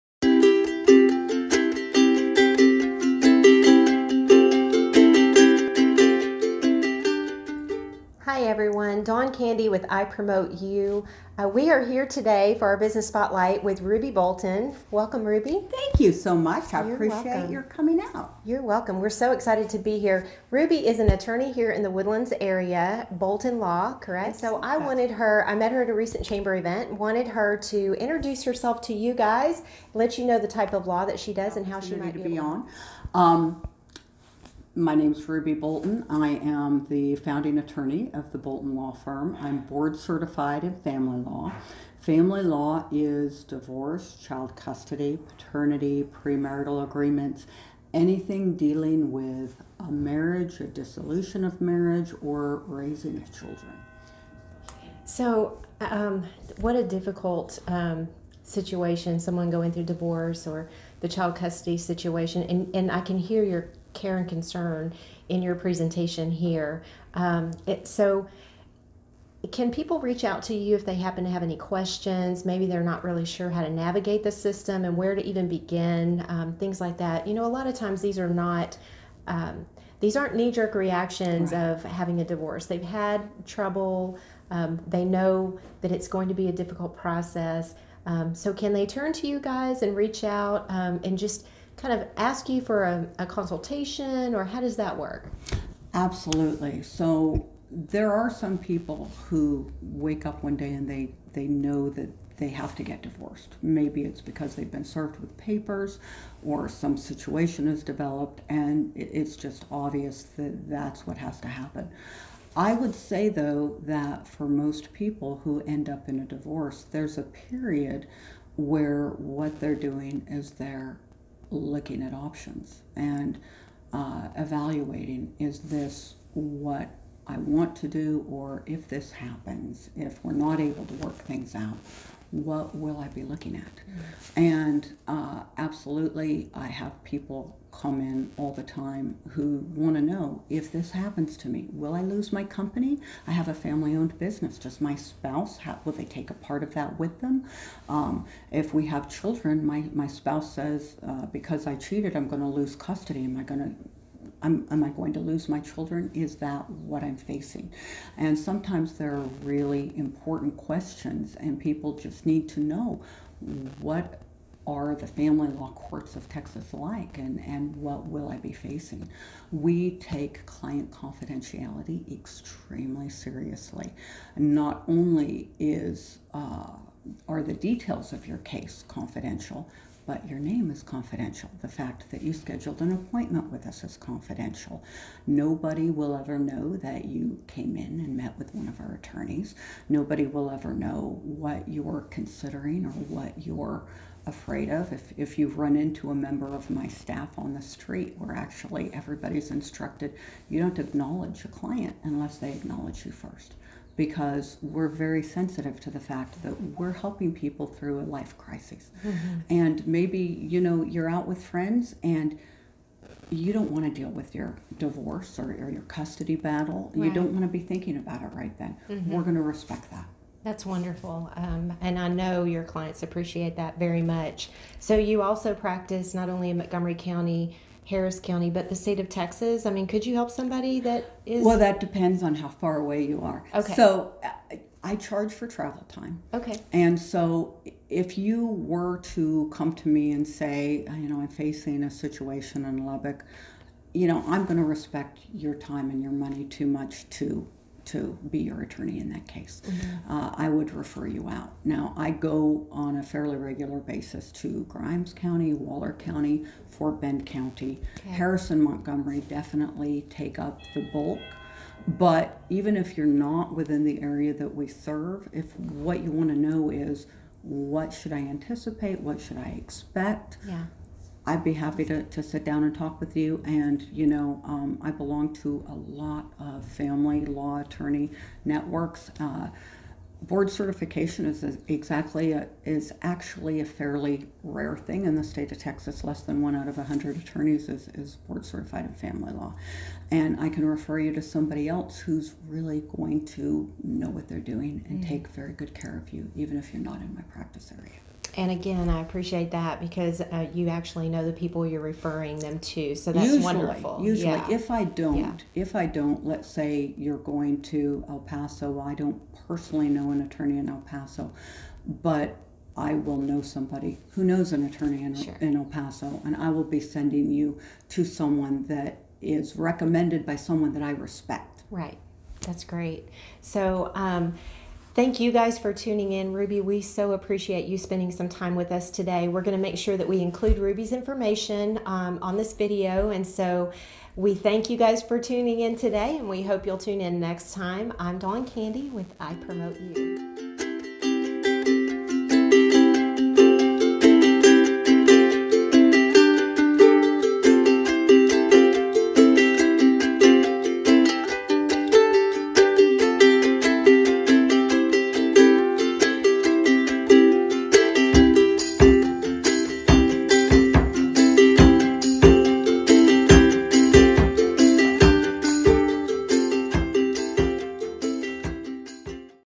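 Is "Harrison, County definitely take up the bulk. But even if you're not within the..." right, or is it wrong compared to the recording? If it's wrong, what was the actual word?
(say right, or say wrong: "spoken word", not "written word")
wrong: "Montgomery", not "County".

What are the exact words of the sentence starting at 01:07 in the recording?
Um, it, so, can people reach out to you if they happen to have any questions?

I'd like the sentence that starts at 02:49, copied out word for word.
We take client confidentiality extremely seriously.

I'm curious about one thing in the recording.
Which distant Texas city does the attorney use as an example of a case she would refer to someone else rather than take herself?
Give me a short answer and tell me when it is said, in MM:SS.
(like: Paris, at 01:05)
Lubbock, at 04:02.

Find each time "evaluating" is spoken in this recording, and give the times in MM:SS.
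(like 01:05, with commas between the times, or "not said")
02:04.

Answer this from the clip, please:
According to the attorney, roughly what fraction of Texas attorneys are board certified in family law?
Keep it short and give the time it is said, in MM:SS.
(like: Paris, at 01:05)
Less than 1 in 100, at 04:46.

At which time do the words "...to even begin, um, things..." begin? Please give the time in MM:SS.
01:15.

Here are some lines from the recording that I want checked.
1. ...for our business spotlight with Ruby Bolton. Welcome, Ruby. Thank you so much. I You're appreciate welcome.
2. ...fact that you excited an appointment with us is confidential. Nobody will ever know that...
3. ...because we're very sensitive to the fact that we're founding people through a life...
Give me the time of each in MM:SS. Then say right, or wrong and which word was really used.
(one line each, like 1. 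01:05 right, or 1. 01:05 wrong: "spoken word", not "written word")
1. 00:12 right
2. 03:01 wrong: "scheduled", not "excited"
3. 03:23 wrong: "helping", not "founding".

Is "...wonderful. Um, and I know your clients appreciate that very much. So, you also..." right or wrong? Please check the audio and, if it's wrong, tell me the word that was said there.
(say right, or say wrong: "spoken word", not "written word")
right.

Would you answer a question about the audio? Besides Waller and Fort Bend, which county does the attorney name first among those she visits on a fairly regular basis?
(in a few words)
Grimes County.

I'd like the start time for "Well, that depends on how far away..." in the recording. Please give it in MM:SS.
03:51.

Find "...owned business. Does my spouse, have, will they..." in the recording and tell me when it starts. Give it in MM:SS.
02:23.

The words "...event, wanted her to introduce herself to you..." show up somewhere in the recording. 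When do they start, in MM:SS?
00:26.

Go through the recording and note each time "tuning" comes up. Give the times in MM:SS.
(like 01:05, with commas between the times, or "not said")
05:25, 05:35.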